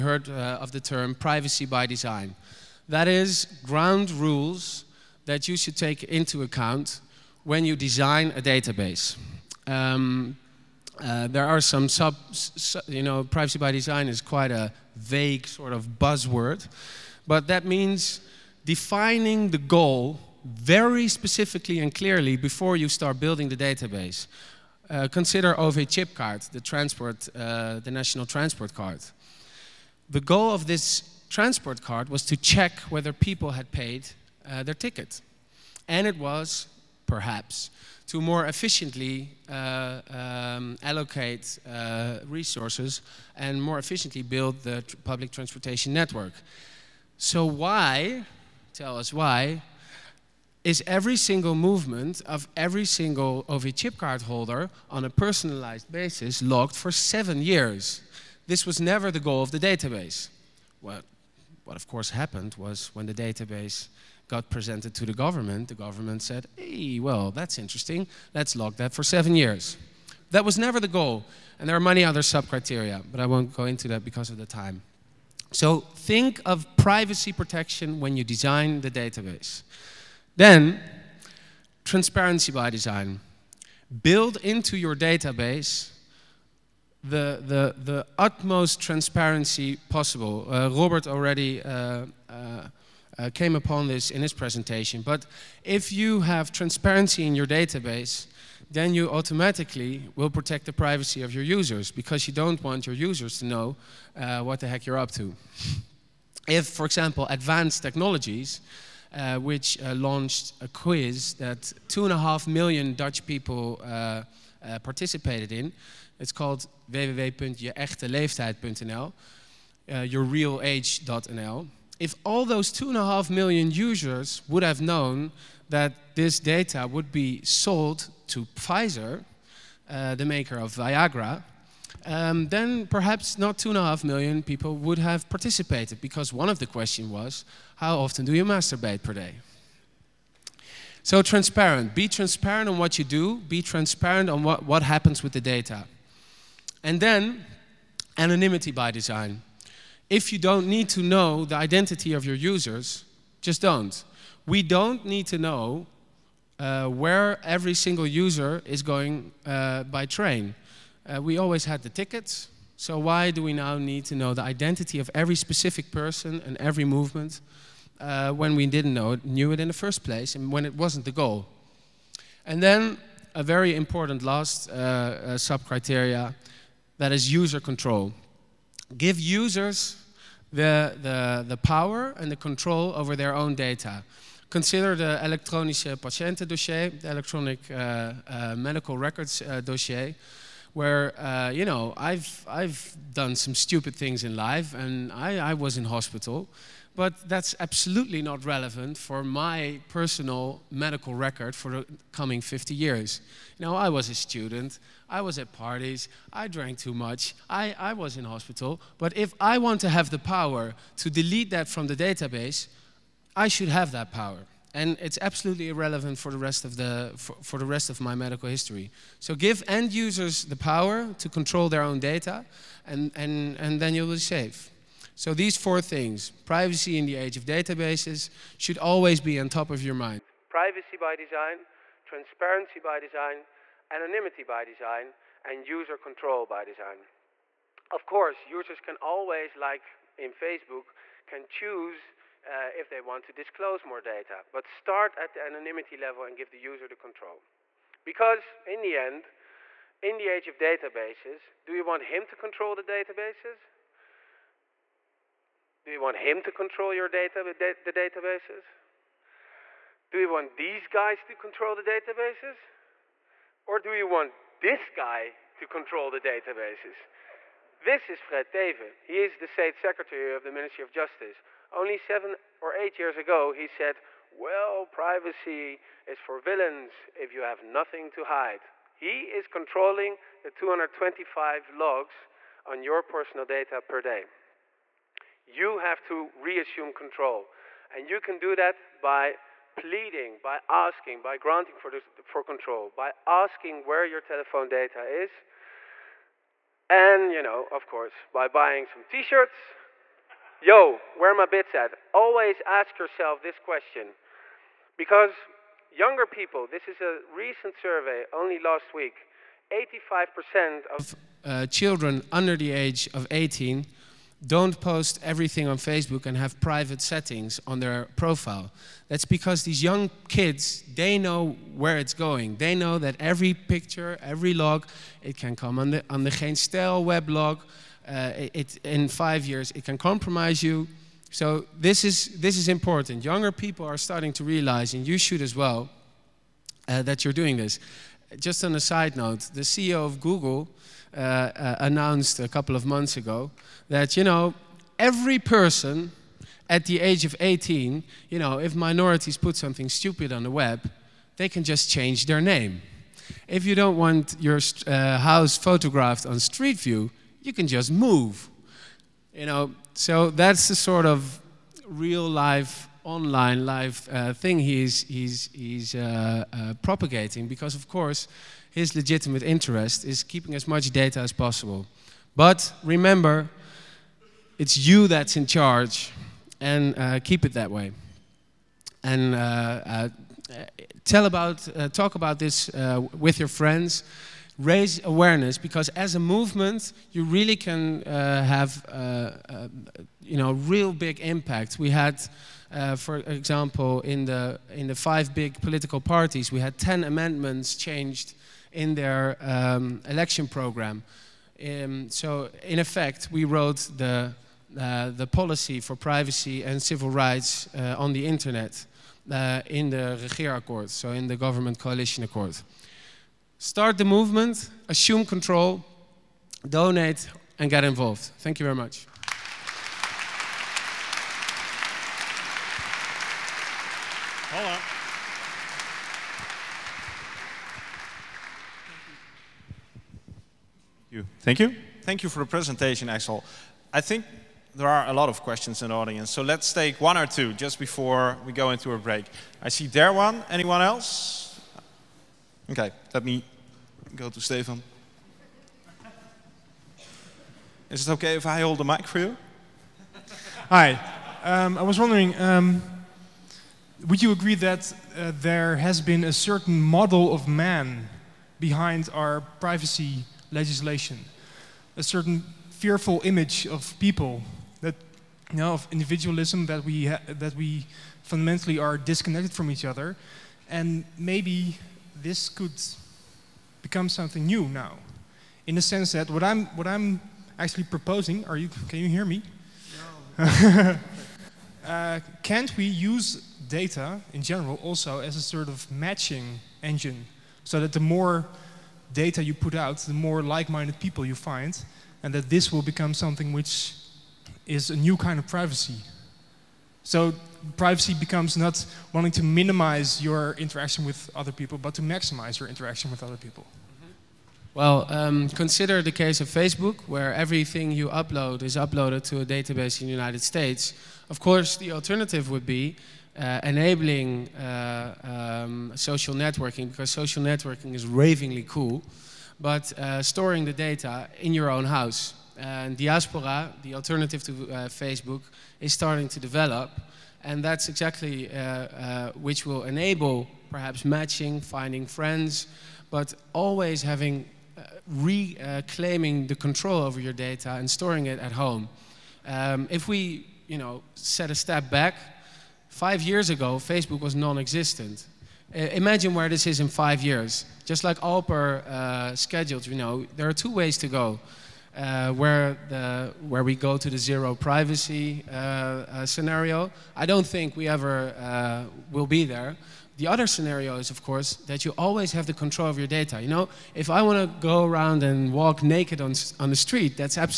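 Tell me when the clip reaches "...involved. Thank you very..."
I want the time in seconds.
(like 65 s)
417 s.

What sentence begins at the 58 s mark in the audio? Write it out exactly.
This was never the goal of the database.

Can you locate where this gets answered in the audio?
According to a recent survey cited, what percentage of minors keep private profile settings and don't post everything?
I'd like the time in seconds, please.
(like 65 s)
309 s.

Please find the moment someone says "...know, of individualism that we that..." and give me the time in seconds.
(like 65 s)
465 s.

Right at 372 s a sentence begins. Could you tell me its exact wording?
But remember, it's you that's in charge and uh, keep it that way.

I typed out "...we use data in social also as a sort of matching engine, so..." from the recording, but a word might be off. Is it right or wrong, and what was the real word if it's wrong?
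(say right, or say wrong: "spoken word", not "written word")
wrong: "general", not "social".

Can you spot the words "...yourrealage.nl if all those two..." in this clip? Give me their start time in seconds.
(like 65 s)
119 s.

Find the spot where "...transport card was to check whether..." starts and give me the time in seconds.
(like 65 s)
31 s.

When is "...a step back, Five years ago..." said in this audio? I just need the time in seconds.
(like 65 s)
541 s.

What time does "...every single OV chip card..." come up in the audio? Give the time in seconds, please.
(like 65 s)
52 s.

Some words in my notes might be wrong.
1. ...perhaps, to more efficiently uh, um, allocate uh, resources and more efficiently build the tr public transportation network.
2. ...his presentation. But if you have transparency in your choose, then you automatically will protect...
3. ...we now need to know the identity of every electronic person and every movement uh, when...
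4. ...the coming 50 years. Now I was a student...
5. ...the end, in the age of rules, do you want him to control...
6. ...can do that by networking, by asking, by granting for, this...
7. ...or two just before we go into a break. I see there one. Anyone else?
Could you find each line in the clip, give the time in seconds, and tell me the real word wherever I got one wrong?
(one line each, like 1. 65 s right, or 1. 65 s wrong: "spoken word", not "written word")
1. 37 s right
2. 94 s wrong: "database", not "choose"
3. 163 s wrong: "specific", not "electronic"
4. 201 s right
5. 248 s wrong: "databases", not "rules"
6. 288 s wrong: "pleading", not "networking"
7. 437 s right.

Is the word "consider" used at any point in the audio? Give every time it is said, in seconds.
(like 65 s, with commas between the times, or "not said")
25 s, 184 s, 505 s.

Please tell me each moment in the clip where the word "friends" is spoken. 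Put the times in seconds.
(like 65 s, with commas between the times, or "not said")
383 s, 532 s.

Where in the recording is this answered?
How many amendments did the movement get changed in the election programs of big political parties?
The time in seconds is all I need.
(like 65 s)
396 s.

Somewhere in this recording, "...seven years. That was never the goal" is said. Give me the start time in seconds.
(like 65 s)
69 s.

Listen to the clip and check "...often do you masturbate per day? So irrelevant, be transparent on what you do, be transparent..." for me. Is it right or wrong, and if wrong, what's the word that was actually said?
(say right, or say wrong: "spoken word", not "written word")
wrong: "transparent", not "irrelevant".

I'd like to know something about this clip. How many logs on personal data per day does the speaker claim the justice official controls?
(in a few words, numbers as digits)
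225.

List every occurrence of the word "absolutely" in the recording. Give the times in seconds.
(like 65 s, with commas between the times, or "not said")
197 s, 215 s.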